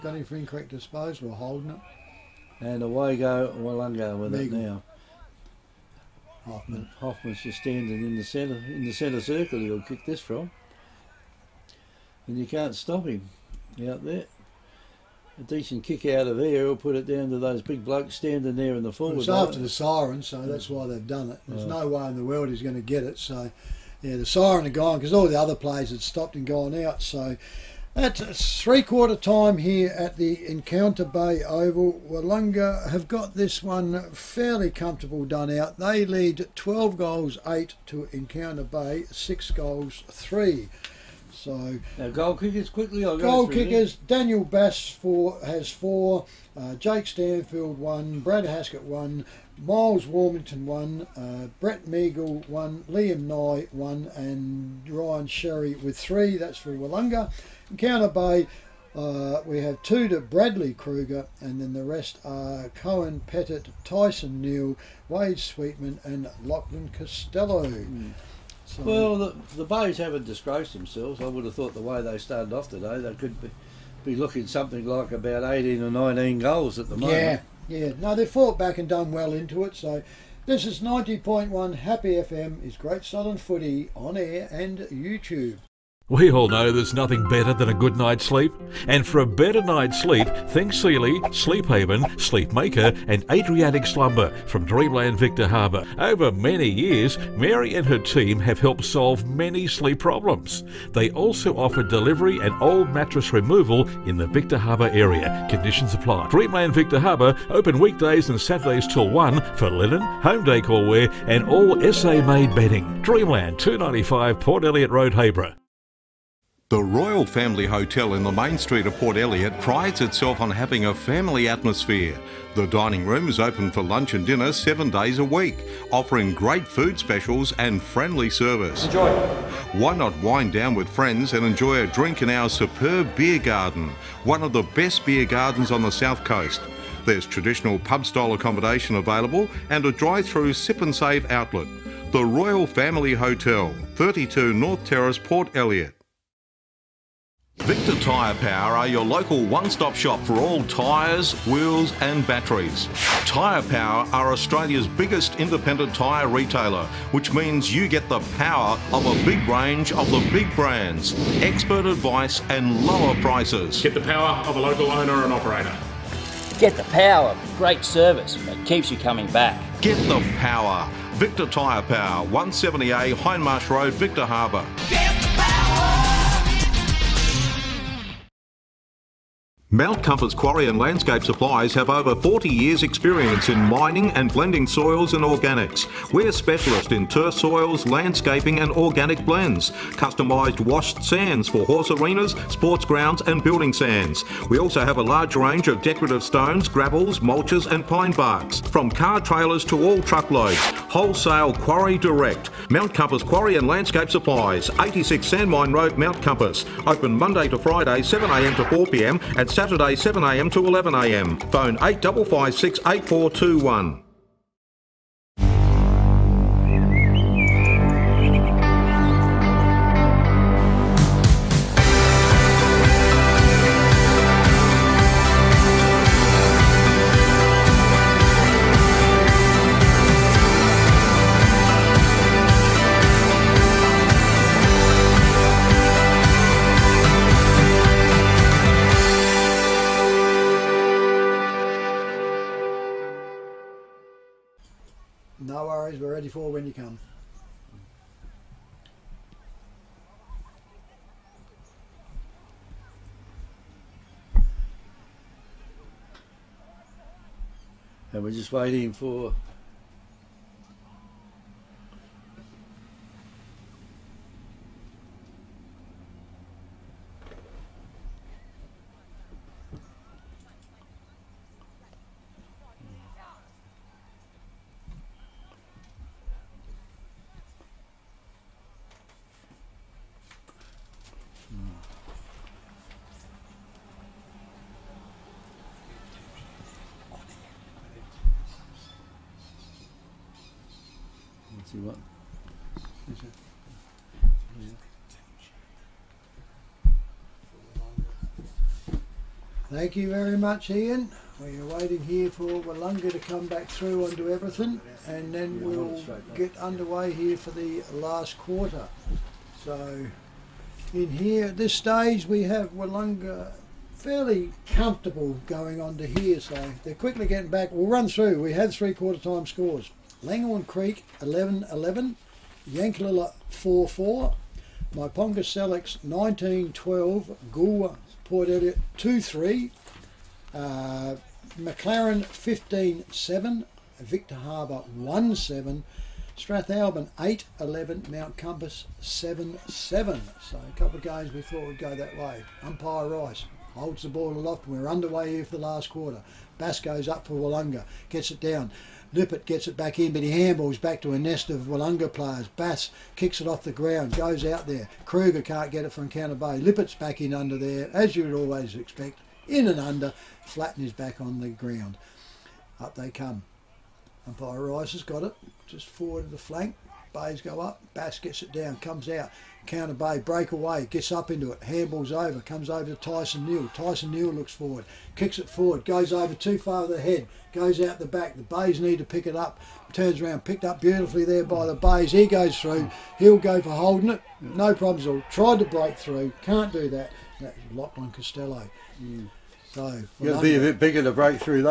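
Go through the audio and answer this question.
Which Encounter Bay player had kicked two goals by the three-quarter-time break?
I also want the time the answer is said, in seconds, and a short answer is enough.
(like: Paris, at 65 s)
Bradley Kruger, at 60 s.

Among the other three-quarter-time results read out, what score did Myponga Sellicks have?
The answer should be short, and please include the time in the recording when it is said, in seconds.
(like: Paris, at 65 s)
19 12, at 324 s.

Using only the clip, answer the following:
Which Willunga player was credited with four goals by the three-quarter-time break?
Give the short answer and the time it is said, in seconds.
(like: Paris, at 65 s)
Daniel Bass, at 44 s.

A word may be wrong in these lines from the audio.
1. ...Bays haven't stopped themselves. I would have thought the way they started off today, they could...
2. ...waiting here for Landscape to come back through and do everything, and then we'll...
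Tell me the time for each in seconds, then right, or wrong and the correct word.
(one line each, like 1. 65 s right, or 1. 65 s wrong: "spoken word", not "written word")
1. 69 s wrong: "disgraced", not "stopped"
2. 301 s wrong: "Willunga", not "Landscape".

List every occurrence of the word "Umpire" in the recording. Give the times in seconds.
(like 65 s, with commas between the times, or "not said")
342 s, 364 s.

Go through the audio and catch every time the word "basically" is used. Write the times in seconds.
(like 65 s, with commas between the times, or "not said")
not said.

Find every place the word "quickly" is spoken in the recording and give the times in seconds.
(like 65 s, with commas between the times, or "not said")
42 s, 316 s.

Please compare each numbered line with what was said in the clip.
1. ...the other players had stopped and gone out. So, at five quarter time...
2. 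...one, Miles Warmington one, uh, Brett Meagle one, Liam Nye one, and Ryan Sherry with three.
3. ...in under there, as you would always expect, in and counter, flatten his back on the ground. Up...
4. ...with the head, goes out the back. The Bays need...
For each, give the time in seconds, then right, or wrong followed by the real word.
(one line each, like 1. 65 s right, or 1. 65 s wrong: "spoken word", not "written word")
1. 25 s wrong: "three", not "five"
2. 48 s right
3. 357 s wrong: "under", not "counter"
4. 376 s right.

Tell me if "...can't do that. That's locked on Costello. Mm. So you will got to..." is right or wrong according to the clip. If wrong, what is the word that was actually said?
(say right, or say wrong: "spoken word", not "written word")
right.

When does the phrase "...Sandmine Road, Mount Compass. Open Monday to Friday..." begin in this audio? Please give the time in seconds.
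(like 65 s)
205 s.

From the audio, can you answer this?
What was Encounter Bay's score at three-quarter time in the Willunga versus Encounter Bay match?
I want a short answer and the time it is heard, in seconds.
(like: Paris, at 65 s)
6 goals 3, at 39 s.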